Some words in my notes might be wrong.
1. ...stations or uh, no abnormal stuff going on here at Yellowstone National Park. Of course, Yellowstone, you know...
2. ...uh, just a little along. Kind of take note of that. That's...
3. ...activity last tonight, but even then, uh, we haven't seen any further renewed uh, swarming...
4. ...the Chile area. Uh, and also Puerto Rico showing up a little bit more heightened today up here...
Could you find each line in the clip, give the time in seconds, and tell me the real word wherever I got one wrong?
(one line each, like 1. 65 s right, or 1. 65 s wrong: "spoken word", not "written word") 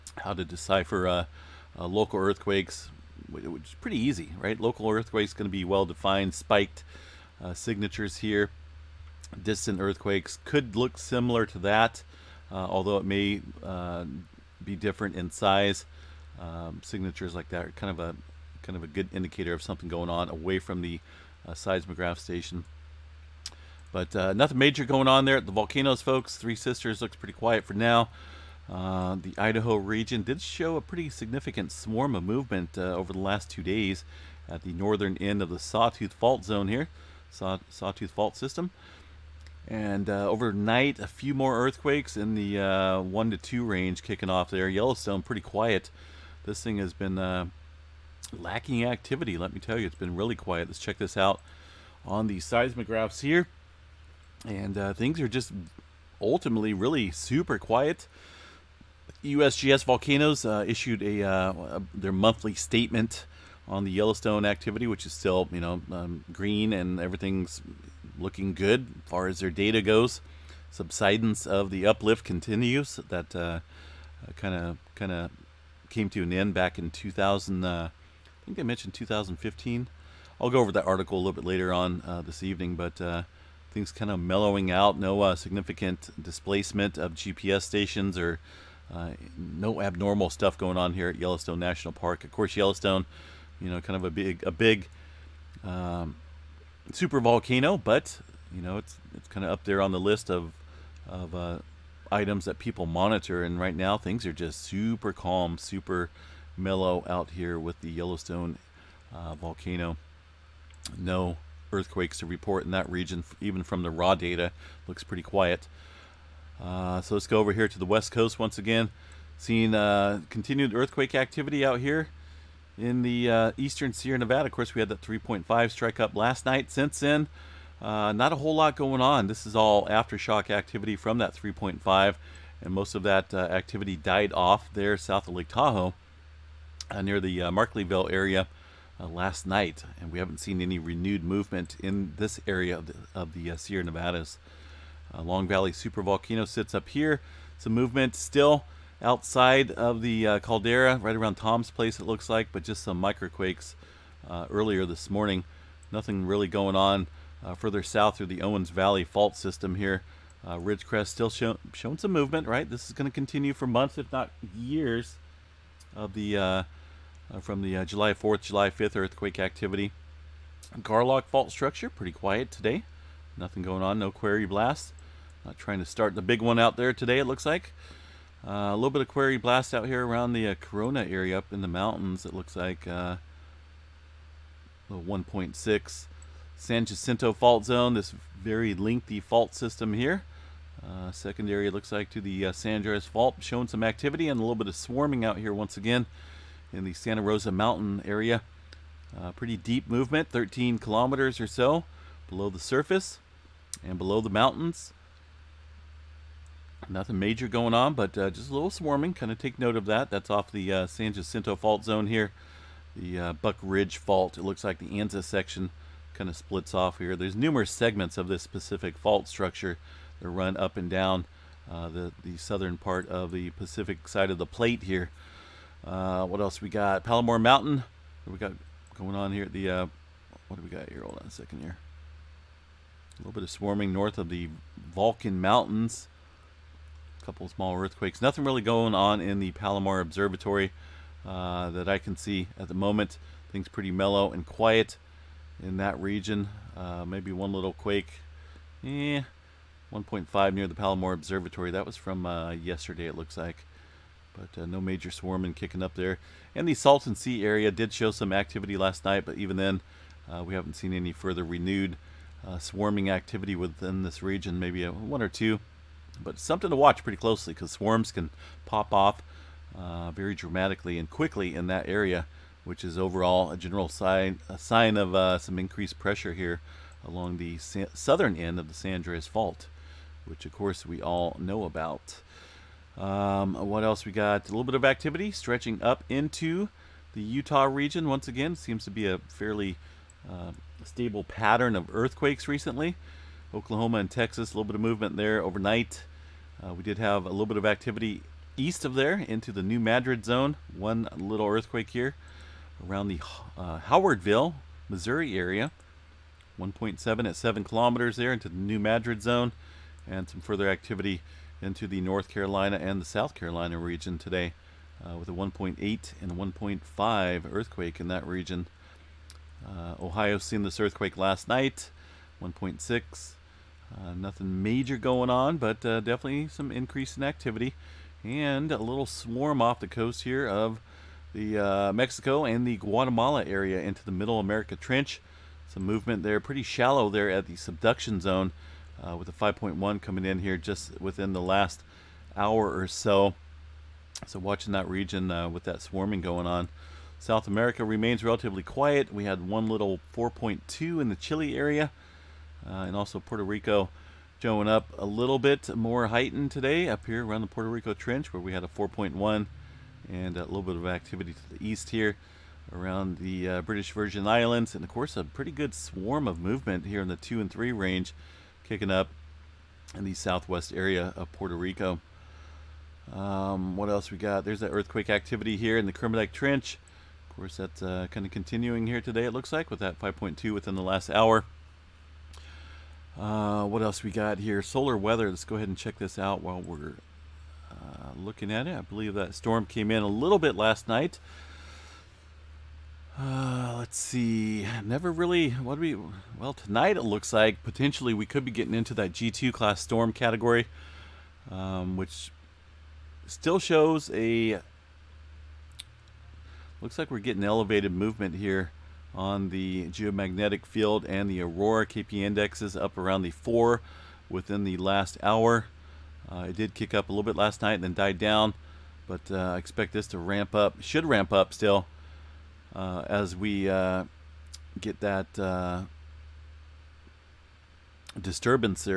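1. 87 s right
2. 208 s wrong: "swarming", not "along"
3. 258 s wrong: "night", not "tonight"
4. 351 s right.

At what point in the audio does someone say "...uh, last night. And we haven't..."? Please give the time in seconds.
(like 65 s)
138 s.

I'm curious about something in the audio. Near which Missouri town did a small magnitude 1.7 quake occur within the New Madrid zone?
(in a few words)
Howardville.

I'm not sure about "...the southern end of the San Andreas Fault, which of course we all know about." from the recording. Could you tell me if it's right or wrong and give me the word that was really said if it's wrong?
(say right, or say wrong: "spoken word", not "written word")
right.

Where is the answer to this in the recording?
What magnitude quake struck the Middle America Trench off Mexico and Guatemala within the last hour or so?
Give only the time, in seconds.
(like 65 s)
339 s.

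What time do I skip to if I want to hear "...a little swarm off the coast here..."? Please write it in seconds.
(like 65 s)
328 s.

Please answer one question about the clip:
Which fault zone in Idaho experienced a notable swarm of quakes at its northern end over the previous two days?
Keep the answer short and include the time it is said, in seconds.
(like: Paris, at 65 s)
Sawtooth Fault Zone, at 35 s.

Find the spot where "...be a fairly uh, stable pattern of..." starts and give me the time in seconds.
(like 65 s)
288 s.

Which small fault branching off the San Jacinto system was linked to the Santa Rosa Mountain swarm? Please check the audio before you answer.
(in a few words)
Buck Ridge Fault.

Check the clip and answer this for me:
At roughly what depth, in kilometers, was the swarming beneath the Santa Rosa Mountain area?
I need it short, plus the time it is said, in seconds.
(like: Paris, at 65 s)
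13, at 200 s.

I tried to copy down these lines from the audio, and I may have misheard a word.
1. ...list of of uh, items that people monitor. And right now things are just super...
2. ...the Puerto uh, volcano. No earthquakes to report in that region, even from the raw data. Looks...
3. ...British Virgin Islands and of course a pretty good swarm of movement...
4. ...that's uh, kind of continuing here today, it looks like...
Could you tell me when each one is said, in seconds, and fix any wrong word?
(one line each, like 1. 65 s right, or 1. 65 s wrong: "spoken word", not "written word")
1. 99 s right
2. 107 s wrong: "Yellowstone", not "Puerto"
3. 363 s right
4. 377 s right.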